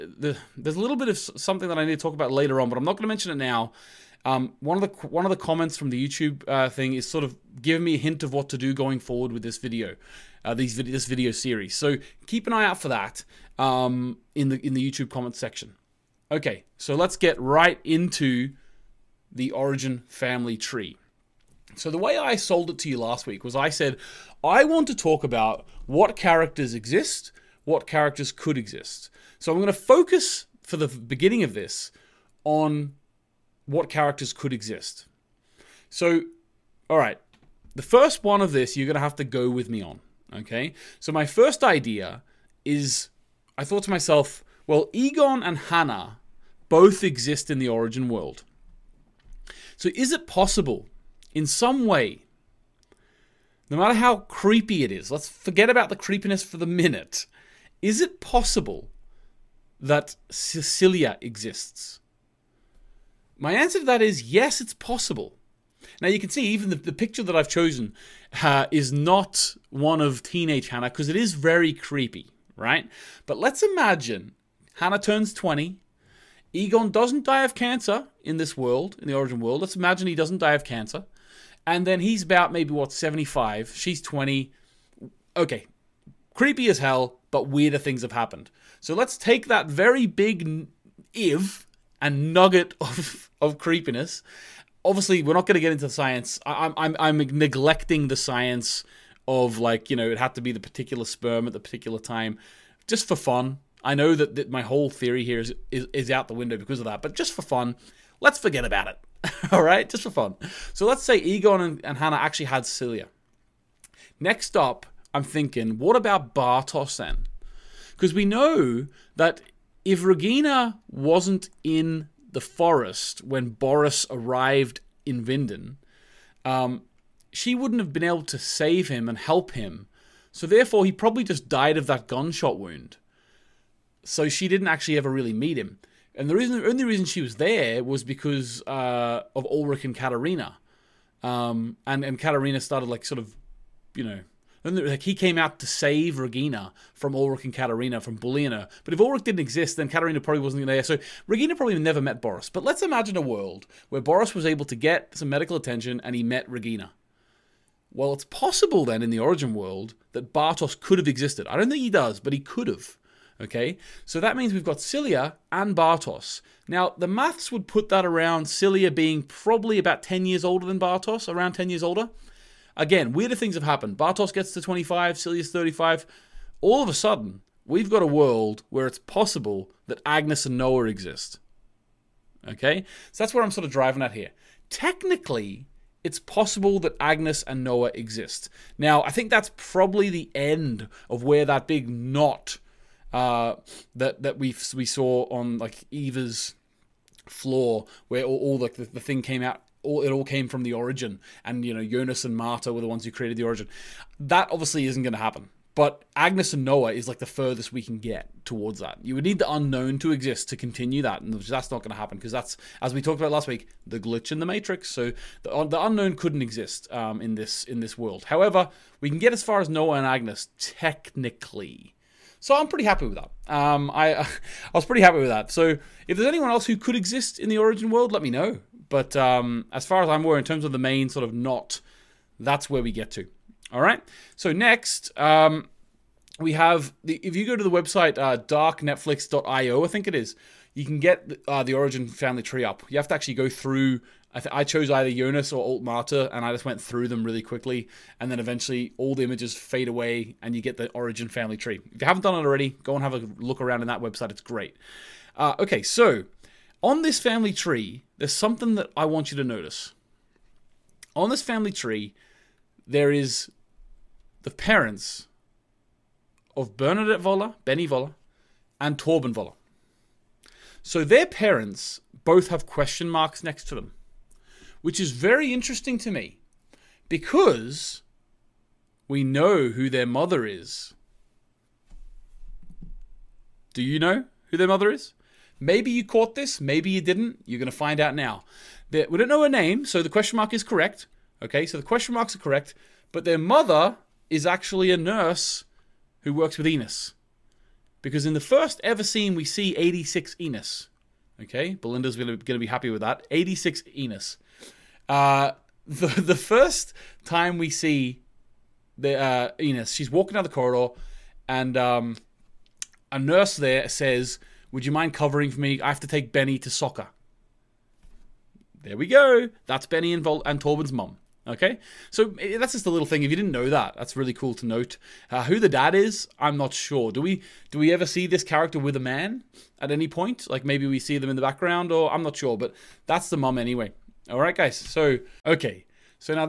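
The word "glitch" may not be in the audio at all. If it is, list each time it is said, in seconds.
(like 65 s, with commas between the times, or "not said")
213 s.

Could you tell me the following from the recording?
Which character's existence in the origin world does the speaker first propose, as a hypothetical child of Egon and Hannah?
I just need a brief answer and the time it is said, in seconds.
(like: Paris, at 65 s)
Cecilia, at 60 s.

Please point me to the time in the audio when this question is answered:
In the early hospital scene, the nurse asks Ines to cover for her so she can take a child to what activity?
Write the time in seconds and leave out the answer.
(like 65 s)
316 s.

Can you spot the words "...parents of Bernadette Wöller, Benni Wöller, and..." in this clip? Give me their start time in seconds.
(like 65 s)
264 s.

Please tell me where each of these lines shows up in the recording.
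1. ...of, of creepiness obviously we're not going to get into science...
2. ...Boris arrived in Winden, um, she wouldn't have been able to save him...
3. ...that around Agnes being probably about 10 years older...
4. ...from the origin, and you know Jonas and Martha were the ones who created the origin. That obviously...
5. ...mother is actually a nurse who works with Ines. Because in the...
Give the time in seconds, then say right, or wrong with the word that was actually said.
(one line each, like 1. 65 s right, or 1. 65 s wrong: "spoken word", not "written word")
1. 92 s right
2. 123 s right
3. 167 s wrong: "Silja", not "Agnes"
4. 200 s right
5. 293 s right.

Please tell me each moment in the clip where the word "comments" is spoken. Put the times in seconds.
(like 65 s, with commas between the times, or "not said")
5 s, 15 s.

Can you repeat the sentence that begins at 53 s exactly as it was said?
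No matter how creepy it is, let's forget about the creepiness for the minute.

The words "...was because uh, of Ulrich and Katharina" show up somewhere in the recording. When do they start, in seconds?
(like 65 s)
137 s.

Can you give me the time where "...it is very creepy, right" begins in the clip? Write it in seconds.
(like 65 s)
71 s.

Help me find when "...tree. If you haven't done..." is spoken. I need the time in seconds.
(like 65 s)
251 s.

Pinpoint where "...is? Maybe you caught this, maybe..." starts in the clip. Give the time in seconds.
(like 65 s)
284 s.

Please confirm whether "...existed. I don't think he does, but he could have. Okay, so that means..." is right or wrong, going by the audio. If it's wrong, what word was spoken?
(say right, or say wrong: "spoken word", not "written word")
right.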